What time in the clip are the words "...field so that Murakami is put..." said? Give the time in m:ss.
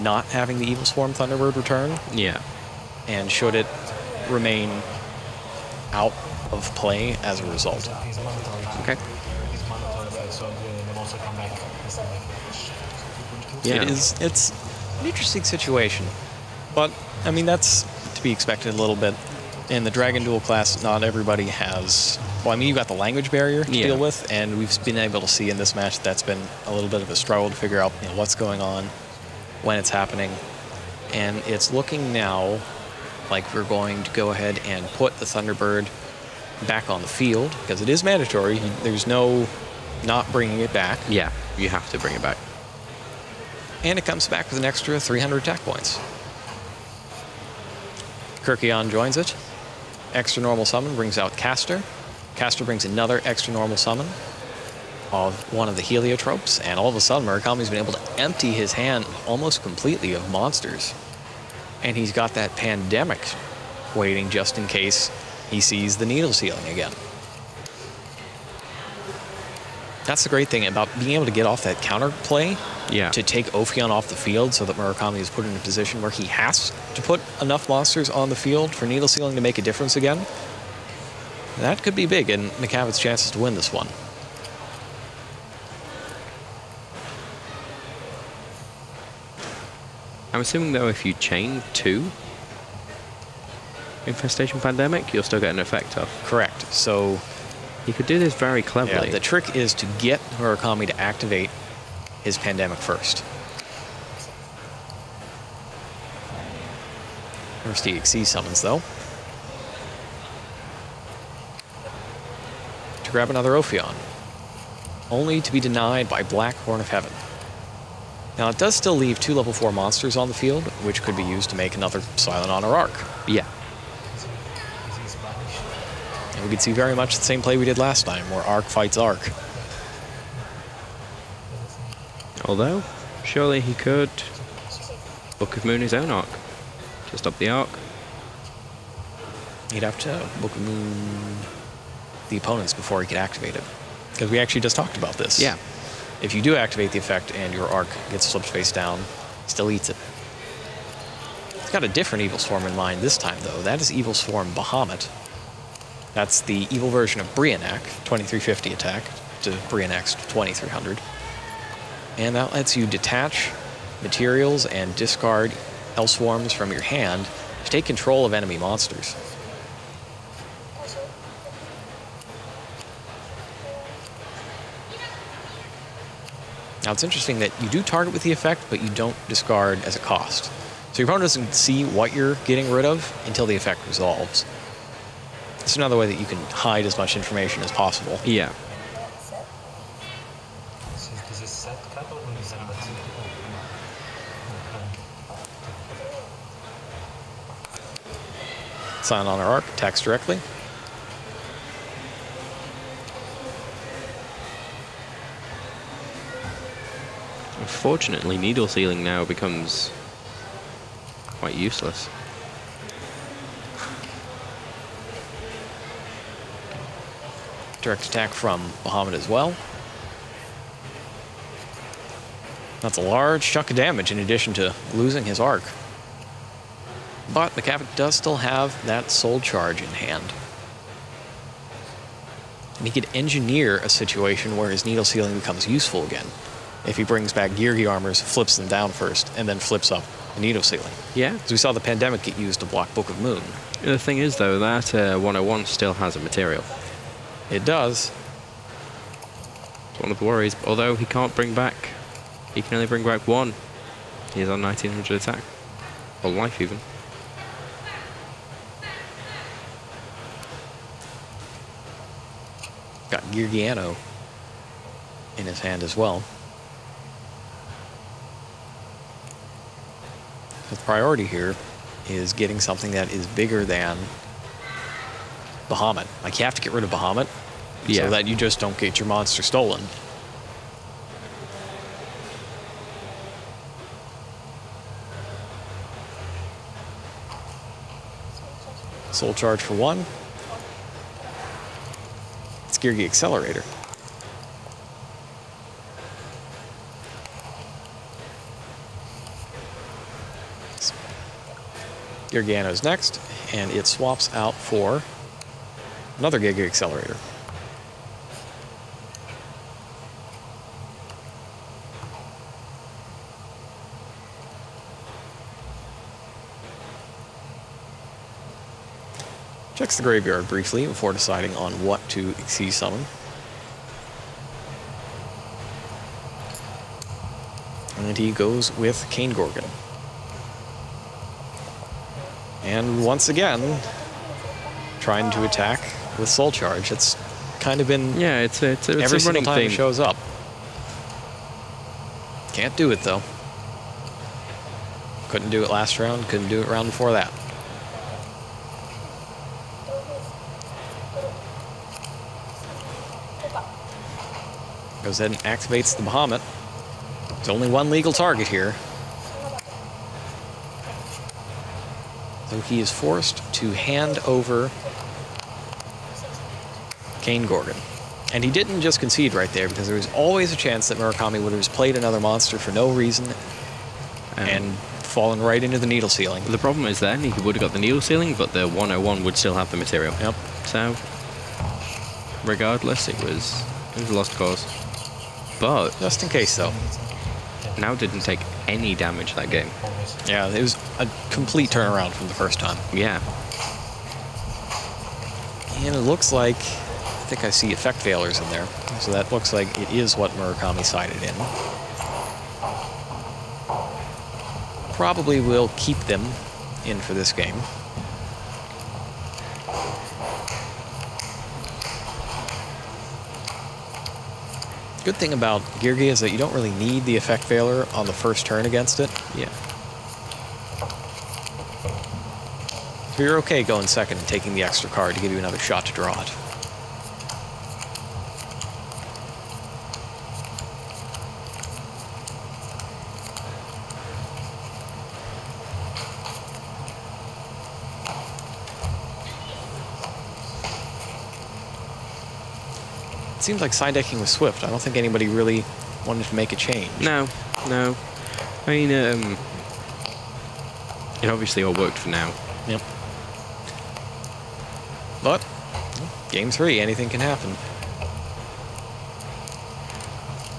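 1:14.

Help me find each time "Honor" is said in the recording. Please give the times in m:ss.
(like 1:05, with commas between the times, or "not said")
2:02, 3:19.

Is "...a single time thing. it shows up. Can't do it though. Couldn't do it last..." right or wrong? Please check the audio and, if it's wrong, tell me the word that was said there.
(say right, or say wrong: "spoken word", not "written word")
right.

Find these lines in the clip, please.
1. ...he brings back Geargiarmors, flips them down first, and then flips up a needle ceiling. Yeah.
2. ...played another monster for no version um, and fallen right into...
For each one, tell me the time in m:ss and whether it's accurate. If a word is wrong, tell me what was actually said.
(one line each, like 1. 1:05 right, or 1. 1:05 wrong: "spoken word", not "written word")
1. 3:56 right
2. 6:11 wrong: "reason", not "version".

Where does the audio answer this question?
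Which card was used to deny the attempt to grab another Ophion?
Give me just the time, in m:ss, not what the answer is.
1:56.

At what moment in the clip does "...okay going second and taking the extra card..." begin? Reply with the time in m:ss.
7:03.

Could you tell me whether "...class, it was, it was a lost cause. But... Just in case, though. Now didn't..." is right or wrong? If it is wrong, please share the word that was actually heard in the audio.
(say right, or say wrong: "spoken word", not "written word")
wrong: "regardless", not "class".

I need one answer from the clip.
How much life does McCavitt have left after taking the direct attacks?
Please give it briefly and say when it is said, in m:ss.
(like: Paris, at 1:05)
1900, at 4:14.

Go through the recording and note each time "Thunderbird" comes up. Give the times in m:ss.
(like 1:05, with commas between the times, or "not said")
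0:01, 0:35.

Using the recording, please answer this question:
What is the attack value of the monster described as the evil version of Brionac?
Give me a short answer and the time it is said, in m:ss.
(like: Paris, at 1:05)
2350, at 2:38.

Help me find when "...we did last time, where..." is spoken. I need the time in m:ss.
2:07.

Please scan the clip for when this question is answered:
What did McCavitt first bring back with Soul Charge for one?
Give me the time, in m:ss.
4:52.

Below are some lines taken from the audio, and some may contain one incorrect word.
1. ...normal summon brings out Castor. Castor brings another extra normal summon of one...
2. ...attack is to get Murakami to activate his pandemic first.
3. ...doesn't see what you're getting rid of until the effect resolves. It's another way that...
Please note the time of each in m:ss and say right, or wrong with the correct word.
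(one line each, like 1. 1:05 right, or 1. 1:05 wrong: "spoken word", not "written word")
1. 0:50 right
2. 1:39 wrong: "trick", not "attack"
3. 3:01 right.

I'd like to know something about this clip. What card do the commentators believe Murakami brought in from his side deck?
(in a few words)
Effect Veiler.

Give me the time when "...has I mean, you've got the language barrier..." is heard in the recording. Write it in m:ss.
0:21.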